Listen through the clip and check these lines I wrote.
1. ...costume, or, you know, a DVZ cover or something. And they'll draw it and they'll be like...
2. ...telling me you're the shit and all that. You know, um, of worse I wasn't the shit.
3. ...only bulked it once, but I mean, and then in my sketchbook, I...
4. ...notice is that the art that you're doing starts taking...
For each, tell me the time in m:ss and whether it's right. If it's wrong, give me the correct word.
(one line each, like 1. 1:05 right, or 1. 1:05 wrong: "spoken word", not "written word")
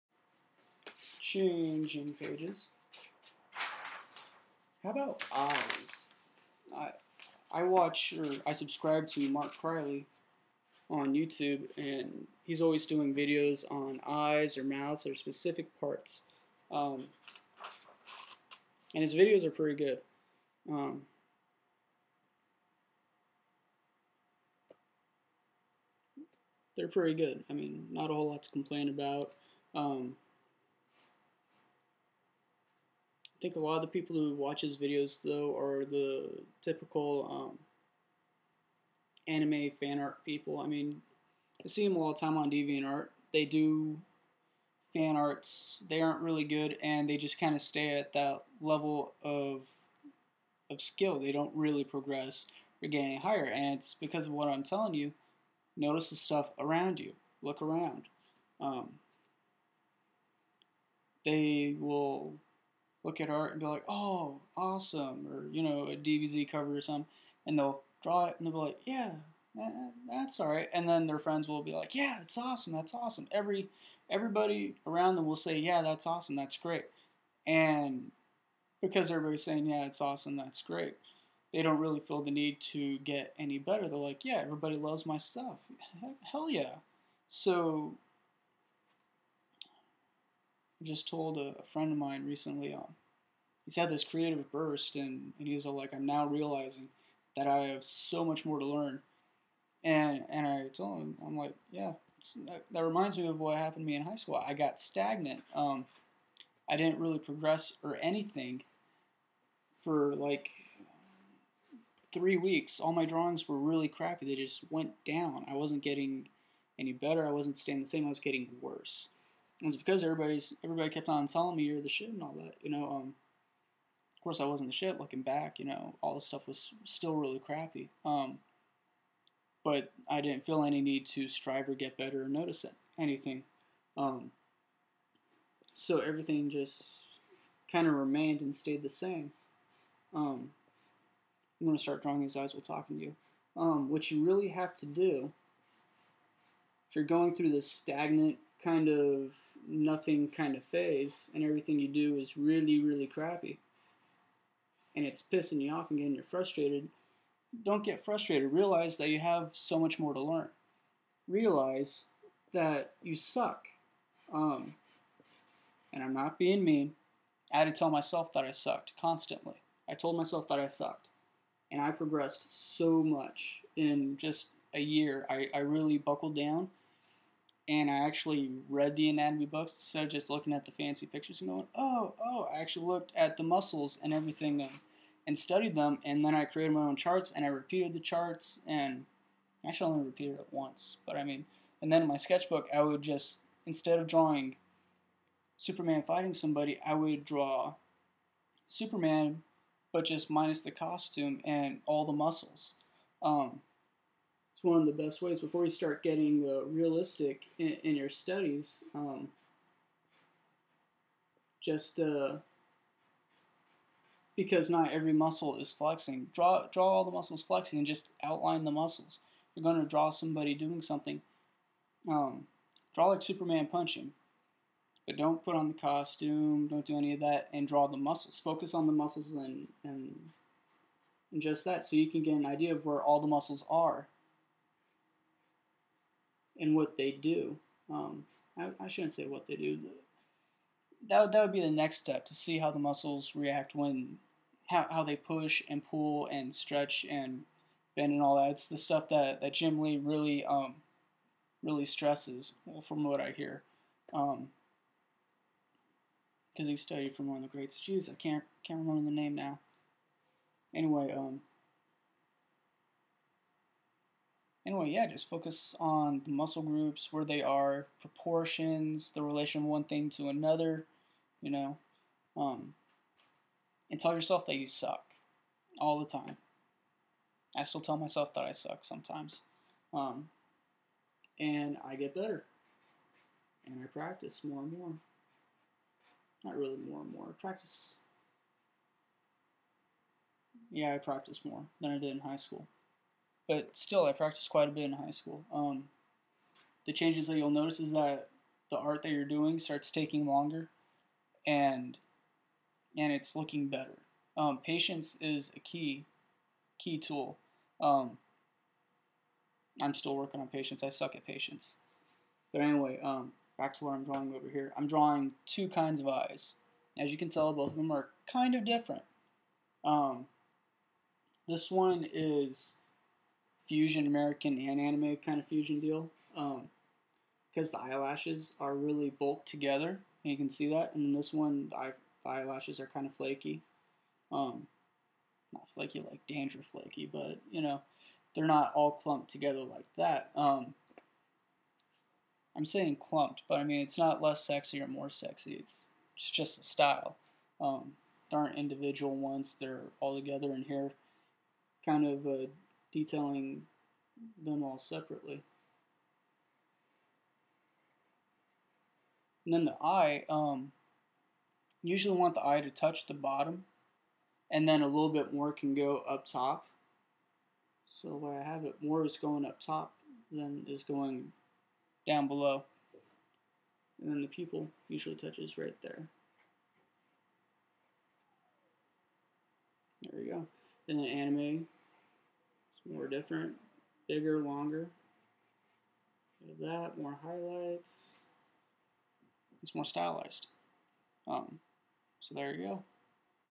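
1. 1:04 wrong: "awesome", not "costume"
2. 2:01 wrong: "course", not "worse"
3. 3:09 wrong: "repeated", not "bulked"
4. 4:57 right.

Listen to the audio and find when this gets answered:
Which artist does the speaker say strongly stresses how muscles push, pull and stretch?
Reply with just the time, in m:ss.
4:09.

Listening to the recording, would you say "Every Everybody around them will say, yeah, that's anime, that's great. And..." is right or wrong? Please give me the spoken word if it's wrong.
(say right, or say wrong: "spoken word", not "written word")
wrong: "awesome", not "anime".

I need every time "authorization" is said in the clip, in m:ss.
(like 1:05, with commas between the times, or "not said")
not said.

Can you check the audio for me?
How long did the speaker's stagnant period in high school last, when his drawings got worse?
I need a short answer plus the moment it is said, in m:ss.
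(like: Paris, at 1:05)
3 weeks, at 1:52.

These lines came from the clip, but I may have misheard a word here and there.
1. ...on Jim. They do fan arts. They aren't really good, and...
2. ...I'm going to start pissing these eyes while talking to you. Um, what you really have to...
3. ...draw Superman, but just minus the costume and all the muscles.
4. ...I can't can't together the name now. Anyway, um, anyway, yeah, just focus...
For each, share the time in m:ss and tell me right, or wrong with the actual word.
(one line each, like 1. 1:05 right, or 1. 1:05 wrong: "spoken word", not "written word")
1. 0:42 wrong: "DeviantArt", not "Jim"
2. 2:21 wrong: "drawing", not "pissing"
3. 3:17 right
4. 4:18 wrong: "remember", not "together".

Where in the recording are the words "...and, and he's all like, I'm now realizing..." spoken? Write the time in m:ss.
1:34.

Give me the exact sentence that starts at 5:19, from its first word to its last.
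Um, this one is fusion American and anime kind of fusion deal.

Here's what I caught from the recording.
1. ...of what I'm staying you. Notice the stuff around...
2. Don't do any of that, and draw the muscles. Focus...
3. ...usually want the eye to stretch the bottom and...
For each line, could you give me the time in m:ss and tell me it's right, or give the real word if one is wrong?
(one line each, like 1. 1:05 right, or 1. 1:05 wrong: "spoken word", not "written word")
1. 0:54 wrong: "telling", not "staying"
2. 3:46 right
3. 6:01 wrong: "touch", not "stretch".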